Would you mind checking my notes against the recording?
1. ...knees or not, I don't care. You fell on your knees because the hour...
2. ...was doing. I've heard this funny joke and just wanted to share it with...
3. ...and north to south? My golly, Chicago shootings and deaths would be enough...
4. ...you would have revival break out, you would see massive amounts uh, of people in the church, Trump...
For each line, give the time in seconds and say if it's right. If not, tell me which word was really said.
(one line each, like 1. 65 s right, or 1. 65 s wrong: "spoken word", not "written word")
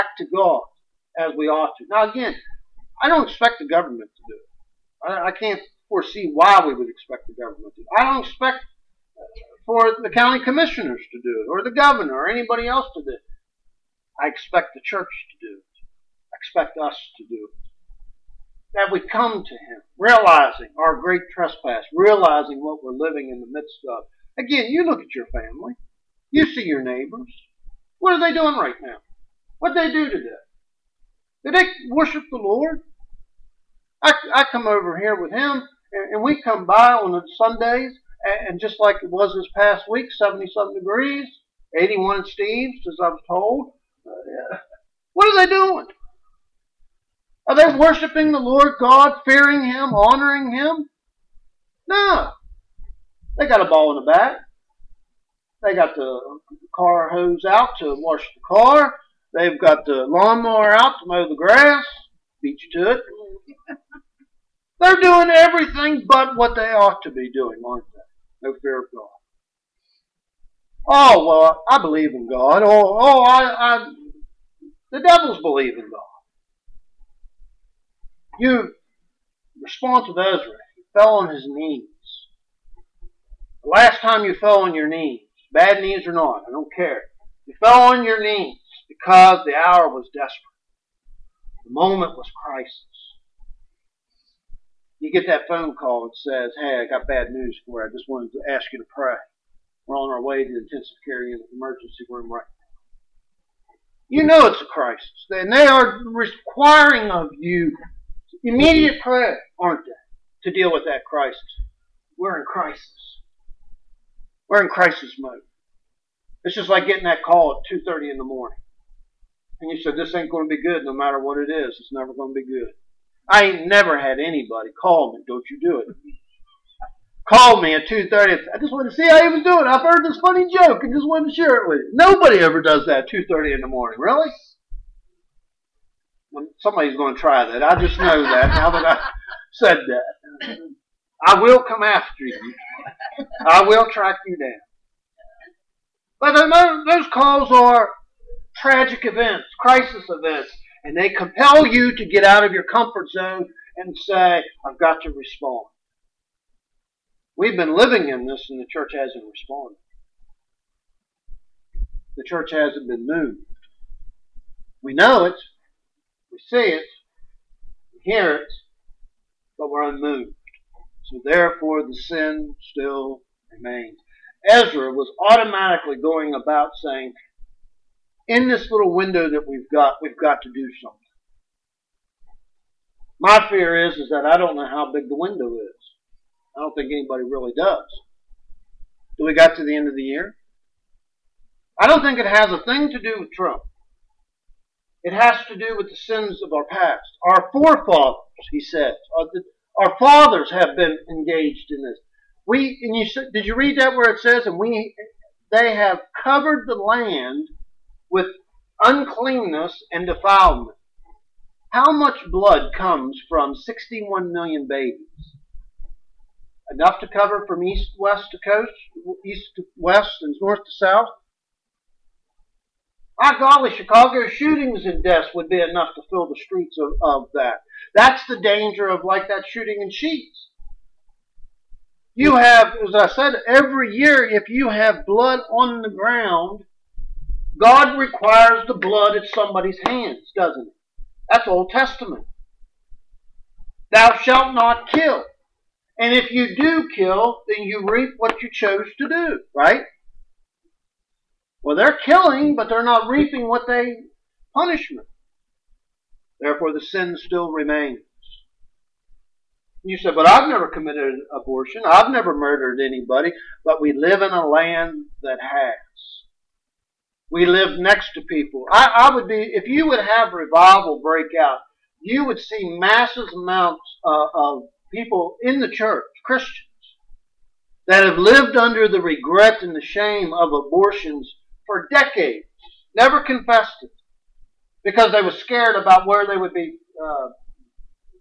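1. 85 s right
2. 129 s right
3. 220 s right
4. 269 s wrong: "Christians", not "Trump".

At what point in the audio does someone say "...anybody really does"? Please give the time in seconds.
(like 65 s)
186 s.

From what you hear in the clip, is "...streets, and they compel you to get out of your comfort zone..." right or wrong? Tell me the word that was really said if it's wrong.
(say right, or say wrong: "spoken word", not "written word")
wrong: "events", not "streets".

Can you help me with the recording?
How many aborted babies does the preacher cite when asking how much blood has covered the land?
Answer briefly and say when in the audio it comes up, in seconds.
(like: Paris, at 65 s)
61 million, at 213 s.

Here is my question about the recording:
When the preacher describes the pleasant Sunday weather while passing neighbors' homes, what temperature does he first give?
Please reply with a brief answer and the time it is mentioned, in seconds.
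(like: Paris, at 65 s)
77 degrees, at 40 s.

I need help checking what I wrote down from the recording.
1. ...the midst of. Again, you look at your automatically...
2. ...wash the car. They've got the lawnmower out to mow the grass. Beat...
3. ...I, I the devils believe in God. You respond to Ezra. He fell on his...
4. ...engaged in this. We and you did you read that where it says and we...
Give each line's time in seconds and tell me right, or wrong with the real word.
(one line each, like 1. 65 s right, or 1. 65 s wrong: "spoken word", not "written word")
1. 23 s wrong: "family", not "automatically"
2. 57 s right
3. 73 s right
4. 201 s right.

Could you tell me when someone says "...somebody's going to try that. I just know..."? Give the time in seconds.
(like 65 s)
136 s.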